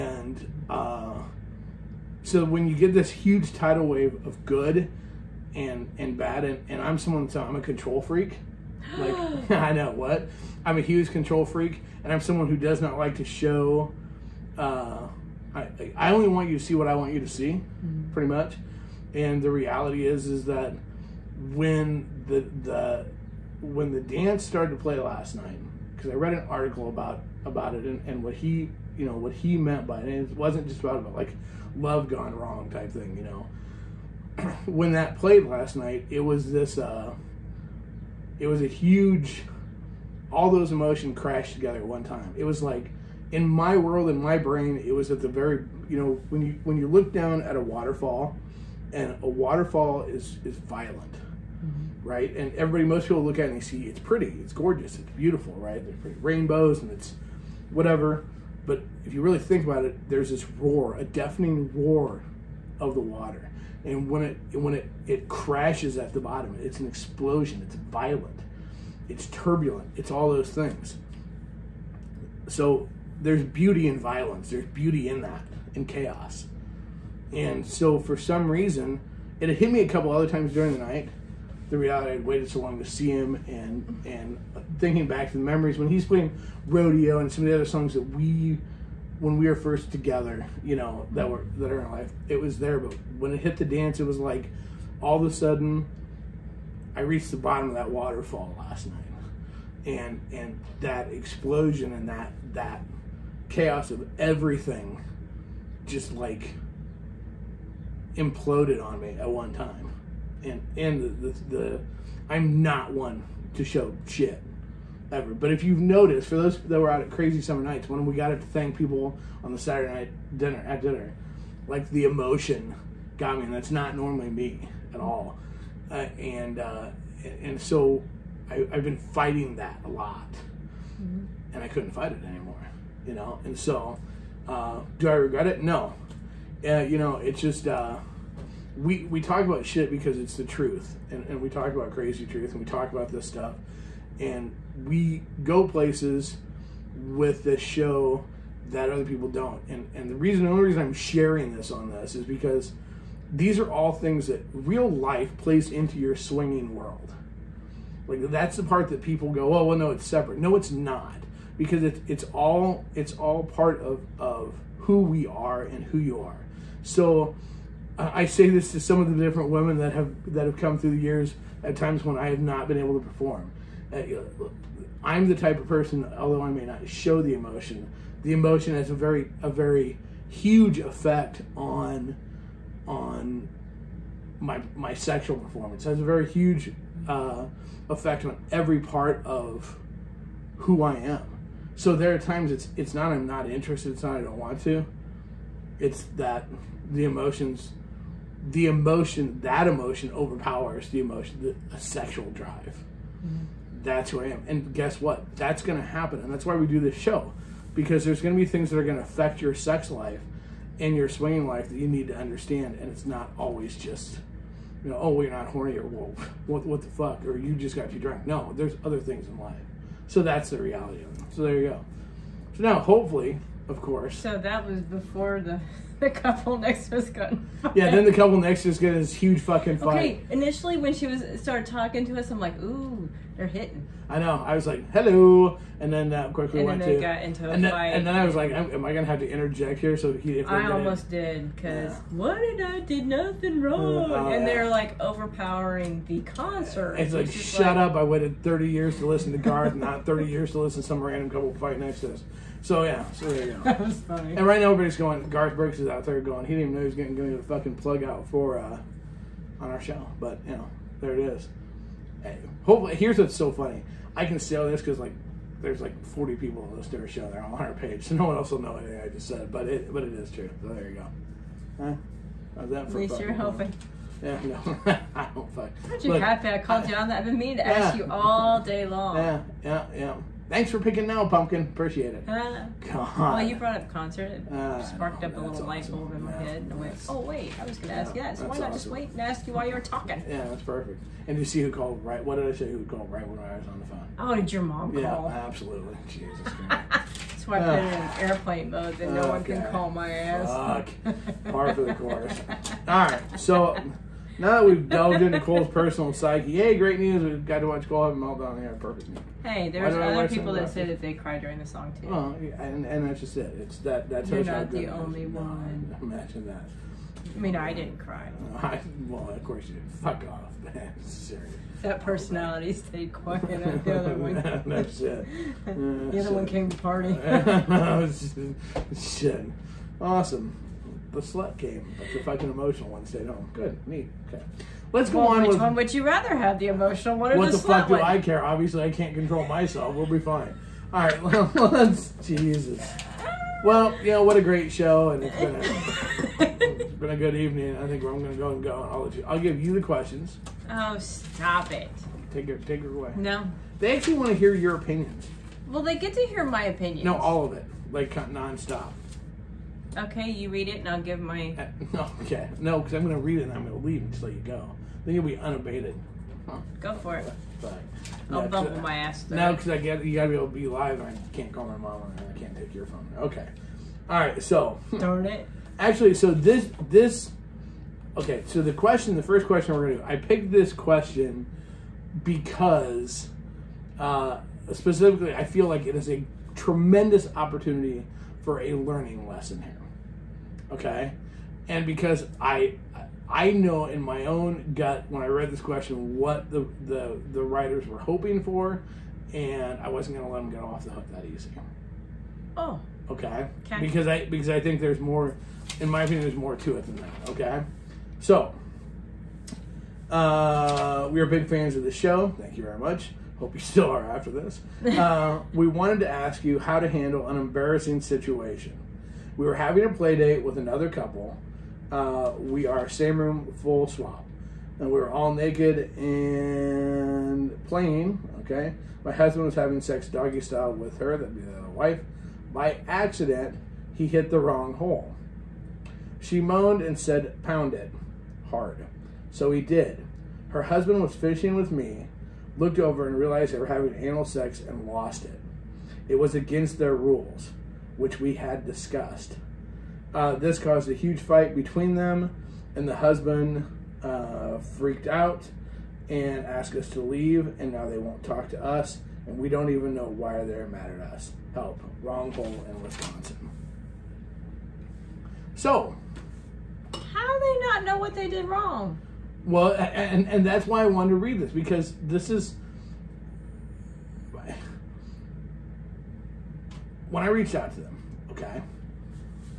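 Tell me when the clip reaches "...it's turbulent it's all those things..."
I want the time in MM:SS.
01:09.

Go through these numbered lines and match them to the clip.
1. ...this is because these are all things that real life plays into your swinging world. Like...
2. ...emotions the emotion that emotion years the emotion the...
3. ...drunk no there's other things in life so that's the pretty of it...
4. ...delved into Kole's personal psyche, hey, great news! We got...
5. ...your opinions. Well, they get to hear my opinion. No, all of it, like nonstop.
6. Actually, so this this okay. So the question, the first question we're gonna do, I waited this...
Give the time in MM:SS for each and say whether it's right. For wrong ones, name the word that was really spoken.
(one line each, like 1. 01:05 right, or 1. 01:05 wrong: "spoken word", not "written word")
1. 02:31 right
2. 03:17 wrong: "overpowers", not "years"
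3. 03:37 wrong: "reality", not "pretty"
4. 05:04 right
5. 05:54 right
6. 06:15 wrong: "picked", not "waited".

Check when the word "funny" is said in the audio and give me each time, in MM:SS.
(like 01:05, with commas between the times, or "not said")
04:14, 04:23.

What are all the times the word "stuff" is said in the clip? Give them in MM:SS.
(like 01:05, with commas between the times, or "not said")
02:23.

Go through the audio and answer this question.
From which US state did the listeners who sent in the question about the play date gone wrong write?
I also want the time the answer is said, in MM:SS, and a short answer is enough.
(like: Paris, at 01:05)
Wisconsin, at 07:42.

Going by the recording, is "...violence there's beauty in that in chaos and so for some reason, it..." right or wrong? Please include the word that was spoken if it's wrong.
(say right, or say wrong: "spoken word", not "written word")
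right.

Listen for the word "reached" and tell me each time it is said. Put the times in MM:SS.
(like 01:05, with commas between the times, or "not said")
01:37, 07:57.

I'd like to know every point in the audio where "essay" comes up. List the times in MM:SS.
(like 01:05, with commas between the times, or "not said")
not said.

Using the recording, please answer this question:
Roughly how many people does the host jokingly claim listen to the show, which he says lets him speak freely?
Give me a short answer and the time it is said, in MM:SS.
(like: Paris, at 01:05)
40, at 04:26.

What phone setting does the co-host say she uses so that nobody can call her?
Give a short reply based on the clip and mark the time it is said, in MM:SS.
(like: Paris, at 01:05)
Airplane mode, at 04:58.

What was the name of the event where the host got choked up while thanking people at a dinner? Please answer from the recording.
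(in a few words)
Crazy Summer Nights.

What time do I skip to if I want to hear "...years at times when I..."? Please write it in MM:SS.
02:51.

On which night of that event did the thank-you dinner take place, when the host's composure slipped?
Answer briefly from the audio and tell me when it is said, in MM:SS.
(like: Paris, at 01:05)
Saturday, at 01:59.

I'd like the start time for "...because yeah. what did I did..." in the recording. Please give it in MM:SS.
04:01.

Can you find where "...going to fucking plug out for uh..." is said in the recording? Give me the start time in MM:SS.
04:17.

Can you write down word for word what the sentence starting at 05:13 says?
It's that that's You're not the only one.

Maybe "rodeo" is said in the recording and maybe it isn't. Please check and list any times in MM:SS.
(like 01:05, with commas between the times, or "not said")
01:26.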